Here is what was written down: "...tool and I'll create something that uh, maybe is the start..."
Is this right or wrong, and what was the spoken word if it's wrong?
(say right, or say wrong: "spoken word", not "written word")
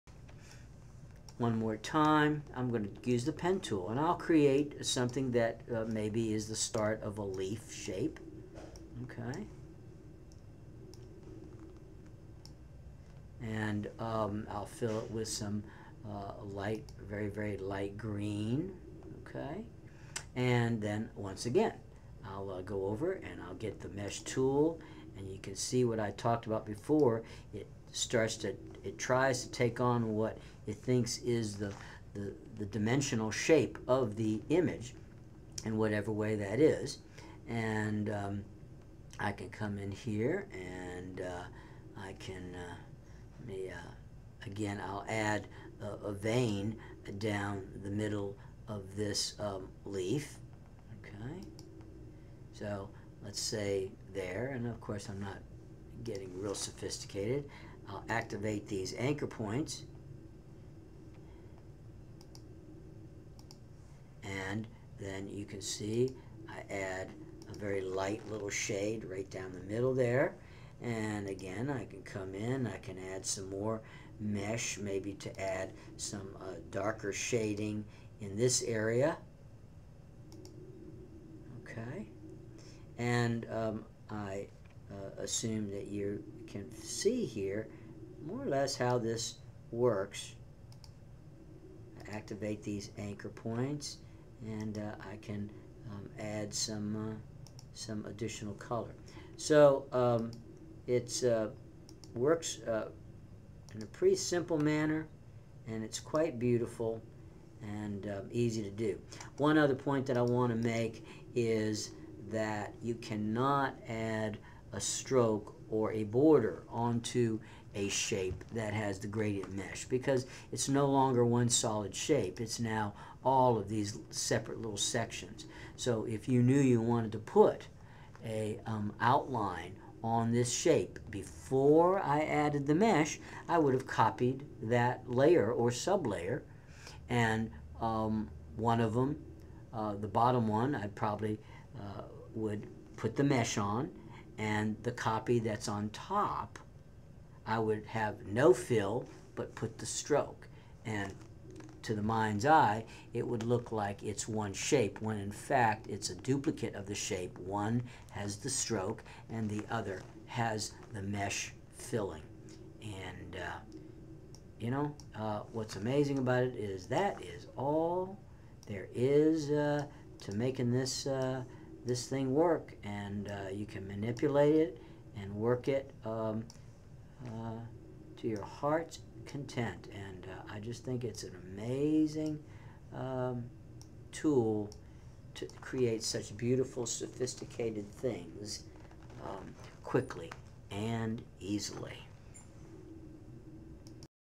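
right.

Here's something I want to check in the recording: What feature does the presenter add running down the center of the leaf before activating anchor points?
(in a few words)
A vein.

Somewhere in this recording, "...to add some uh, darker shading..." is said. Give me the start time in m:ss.
1:15.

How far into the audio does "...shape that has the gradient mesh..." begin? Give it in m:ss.
1:57.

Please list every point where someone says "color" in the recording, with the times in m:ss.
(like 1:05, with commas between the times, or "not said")
1:38.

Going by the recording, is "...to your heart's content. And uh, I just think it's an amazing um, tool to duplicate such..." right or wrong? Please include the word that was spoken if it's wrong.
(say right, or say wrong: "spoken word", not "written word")
wrong: "create", not "duplicate".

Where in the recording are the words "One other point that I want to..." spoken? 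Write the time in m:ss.
1:49.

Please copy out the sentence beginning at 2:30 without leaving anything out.
And to the mind's eye, it would look like it's one shape, when in fact it's a duplicate of the shape.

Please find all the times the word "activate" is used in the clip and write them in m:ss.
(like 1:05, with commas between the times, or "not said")
0:58, 1:32.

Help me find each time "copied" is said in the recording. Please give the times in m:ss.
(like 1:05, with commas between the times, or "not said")
2:13.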